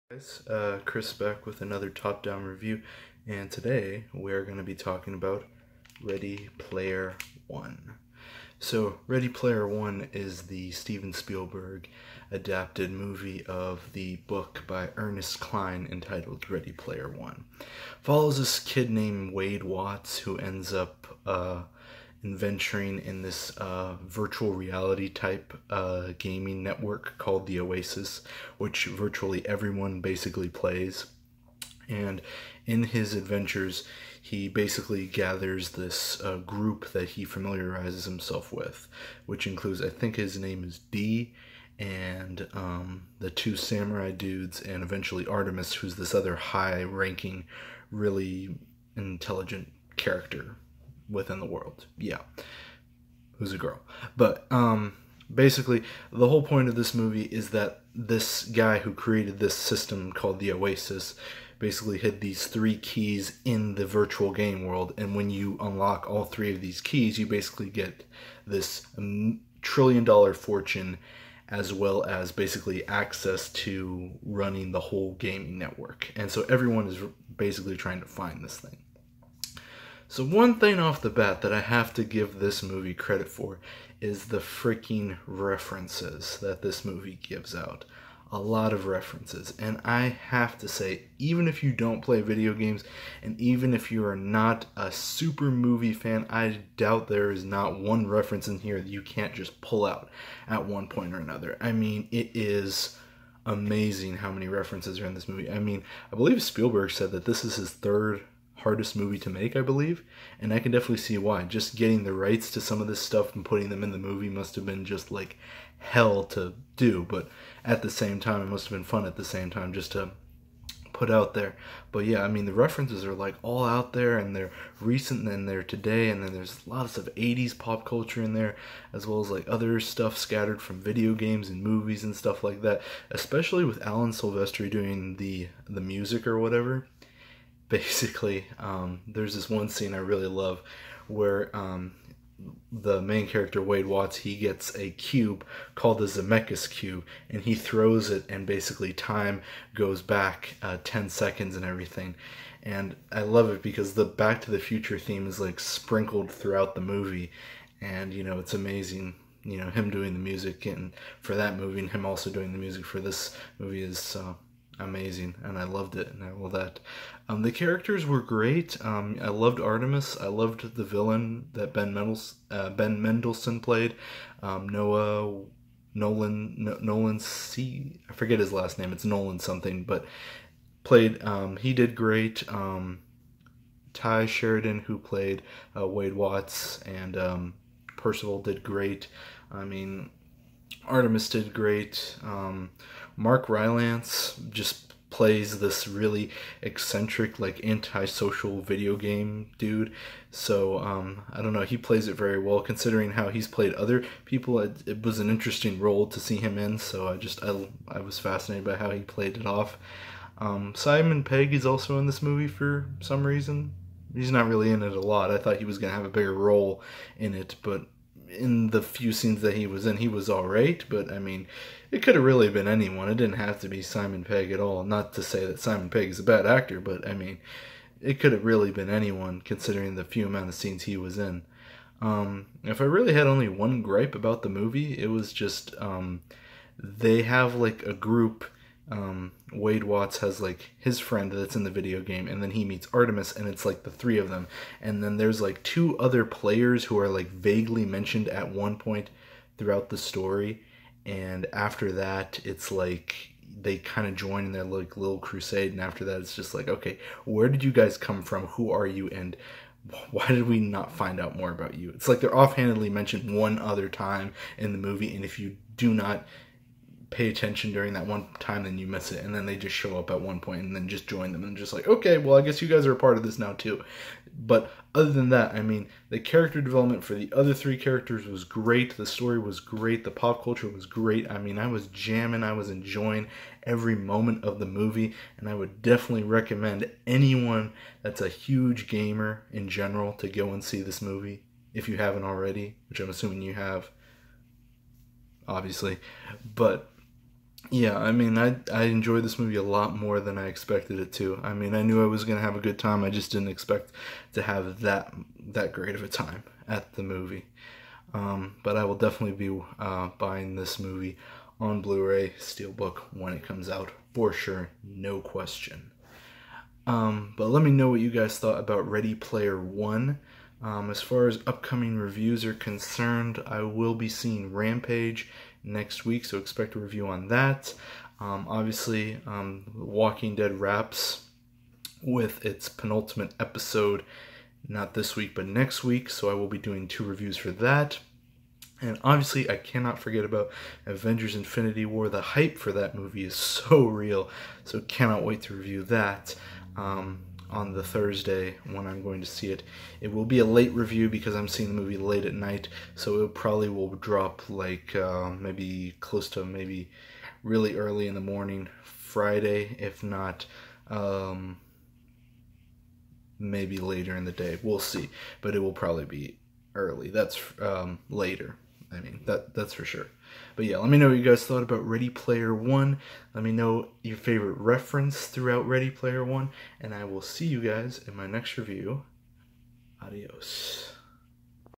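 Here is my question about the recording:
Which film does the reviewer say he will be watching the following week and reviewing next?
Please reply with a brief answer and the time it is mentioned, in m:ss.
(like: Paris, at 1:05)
Rampage, at 5:24.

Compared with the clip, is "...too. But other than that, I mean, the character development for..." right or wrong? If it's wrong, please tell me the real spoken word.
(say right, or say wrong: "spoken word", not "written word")
right.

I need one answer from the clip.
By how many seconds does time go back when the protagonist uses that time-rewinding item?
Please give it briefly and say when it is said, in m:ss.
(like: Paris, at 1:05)
10, at 2:30.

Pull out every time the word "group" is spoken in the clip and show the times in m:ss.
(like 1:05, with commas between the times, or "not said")
0:36, 3:57.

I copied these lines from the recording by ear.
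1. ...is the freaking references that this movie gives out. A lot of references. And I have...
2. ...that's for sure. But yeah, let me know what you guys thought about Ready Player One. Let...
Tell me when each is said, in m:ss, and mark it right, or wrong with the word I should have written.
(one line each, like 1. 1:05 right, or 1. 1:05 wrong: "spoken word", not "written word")
1. 1:24 right
2. 6:09 right.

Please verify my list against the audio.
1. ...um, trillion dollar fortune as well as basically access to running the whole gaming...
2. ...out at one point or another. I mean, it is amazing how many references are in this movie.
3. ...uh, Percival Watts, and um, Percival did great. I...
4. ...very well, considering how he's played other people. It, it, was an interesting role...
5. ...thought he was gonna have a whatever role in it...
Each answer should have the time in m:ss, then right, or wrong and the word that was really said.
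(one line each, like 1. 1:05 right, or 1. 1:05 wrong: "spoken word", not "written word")
1. 1:08 right
2. 1:39 right
3. 3:05 wrong: "Wade", not "Percival"
4. 3:22 right
5. 3:35 wrong: "bigger", not "whatever".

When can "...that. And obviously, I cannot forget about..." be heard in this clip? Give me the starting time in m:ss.
5:37.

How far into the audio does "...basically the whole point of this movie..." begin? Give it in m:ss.
0:55.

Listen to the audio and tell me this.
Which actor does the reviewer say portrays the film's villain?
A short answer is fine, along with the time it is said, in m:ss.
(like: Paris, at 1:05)
Ben Mendelsohn, at 2:52.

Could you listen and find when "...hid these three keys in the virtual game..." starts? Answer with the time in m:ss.
1:01.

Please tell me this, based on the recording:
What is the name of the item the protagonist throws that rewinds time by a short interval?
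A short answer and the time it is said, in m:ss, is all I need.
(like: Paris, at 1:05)
Zemeckis cube, at 2:26.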